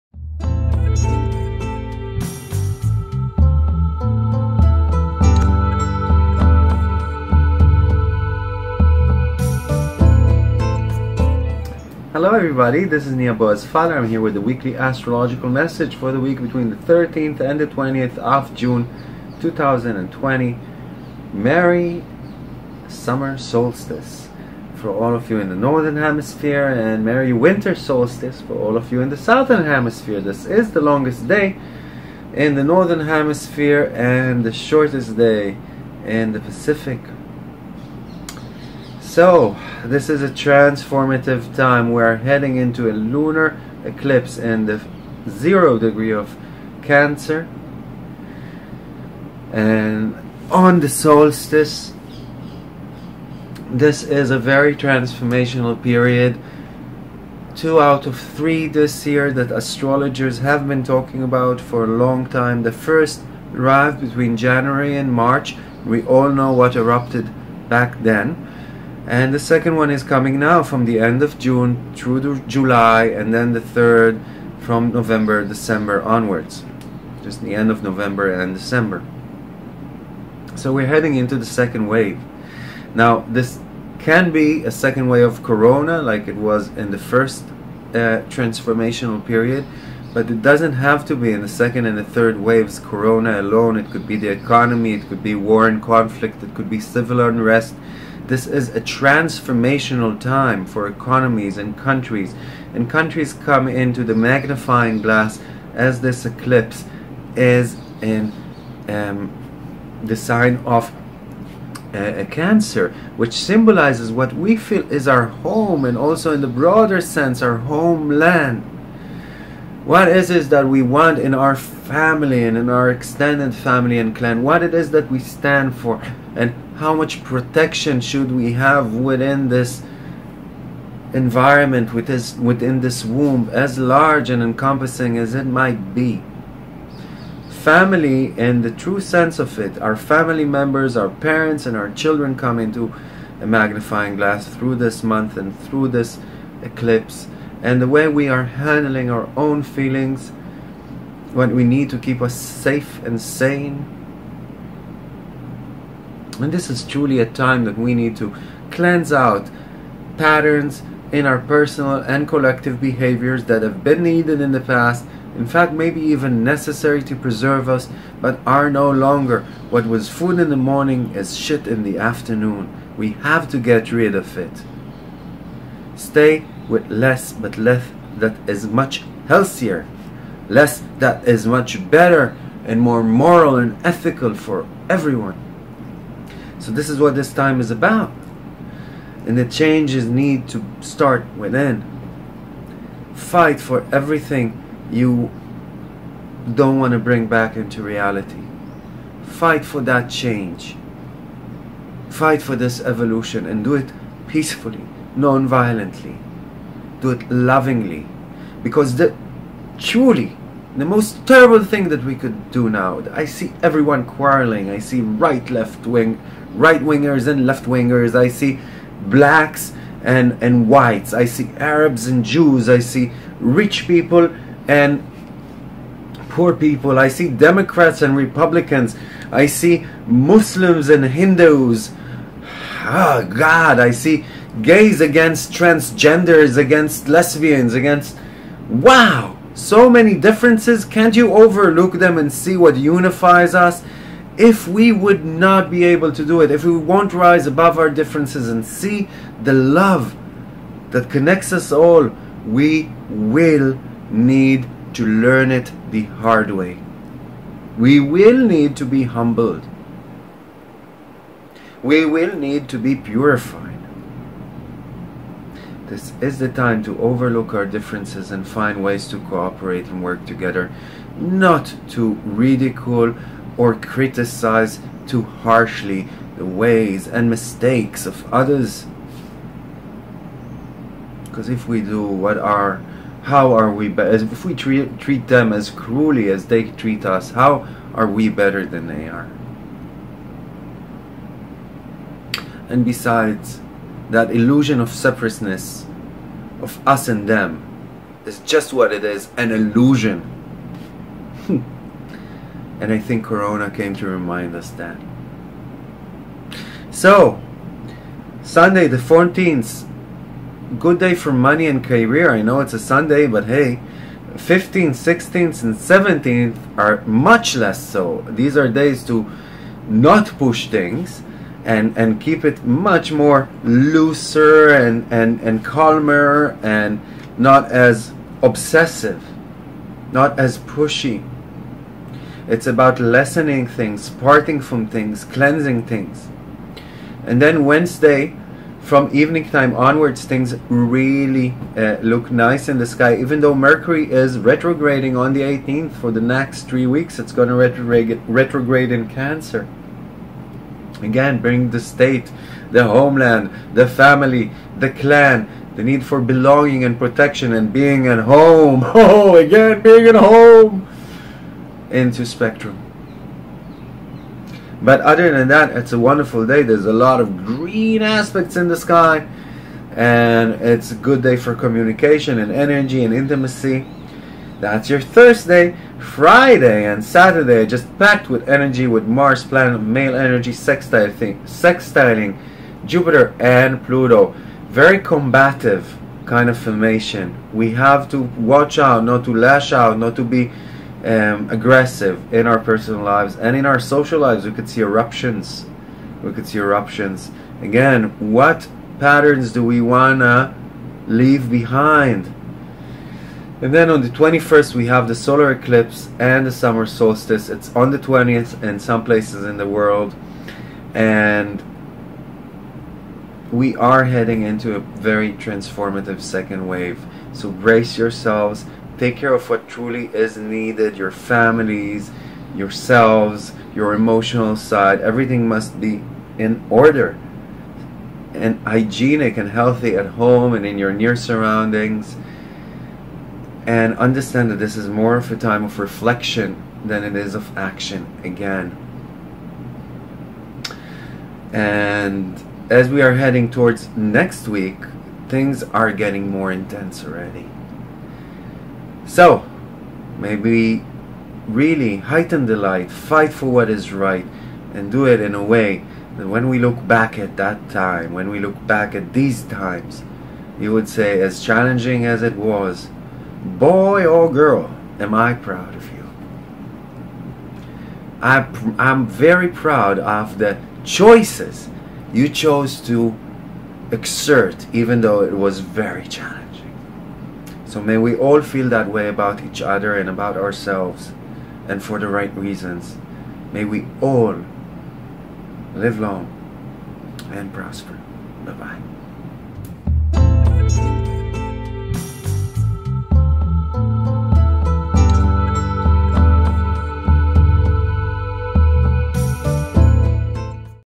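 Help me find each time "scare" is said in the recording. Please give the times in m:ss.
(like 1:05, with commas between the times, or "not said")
not said.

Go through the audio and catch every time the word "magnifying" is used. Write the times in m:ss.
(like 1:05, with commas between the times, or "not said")
1:44, 2:23.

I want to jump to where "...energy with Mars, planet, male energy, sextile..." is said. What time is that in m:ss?
6:18.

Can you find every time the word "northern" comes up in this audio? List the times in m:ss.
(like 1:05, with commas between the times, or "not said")
0:25, 0:32.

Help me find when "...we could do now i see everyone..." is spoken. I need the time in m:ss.
3:32.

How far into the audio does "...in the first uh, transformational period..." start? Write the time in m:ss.
1:26.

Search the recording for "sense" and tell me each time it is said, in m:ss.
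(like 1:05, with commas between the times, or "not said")
1:57, 2:18.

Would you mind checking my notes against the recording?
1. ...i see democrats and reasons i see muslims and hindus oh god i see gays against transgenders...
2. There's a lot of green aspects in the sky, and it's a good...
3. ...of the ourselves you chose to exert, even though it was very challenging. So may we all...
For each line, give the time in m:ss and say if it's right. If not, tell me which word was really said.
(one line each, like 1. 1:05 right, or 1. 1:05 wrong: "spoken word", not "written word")
1. 3:46 wrong: "republicans", not "reasons"
2. 6:06 right
3. 7:49 wrong: "choices", not "ourselves".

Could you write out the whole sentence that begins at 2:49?
What was food in the morning is shit in the afternoon.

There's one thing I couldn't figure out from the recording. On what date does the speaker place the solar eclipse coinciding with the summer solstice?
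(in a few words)
21st.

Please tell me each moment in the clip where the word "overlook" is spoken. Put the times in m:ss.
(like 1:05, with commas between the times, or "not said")
4:01, 4:26.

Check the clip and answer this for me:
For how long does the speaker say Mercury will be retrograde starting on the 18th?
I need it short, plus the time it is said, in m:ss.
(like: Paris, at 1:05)
3 weeks, at 5:46.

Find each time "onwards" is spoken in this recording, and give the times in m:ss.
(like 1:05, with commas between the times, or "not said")
1:16, 5:39.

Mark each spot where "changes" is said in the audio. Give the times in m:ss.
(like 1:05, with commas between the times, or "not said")
3:09, 3:20.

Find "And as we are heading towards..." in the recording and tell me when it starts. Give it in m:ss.
7:21.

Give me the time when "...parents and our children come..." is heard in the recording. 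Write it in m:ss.
2:21.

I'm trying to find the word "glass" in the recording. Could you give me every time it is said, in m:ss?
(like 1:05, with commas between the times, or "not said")
1:45, 2:24.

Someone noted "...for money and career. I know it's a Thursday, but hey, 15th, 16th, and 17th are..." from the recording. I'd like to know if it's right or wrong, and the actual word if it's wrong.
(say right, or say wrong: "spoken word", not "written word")
wrong: "Sunday", not "Thursday".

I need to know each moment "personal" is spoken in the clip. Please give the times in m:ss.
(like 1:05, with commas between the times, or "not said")
2:41, 6:32.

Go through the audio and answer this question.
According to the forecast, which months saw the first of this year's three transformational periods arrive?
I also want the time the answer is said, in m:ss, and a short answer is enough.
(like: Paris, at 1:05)
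January and March, at 1:04.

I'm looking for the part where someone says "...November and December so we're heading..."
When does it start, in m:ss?
1:17.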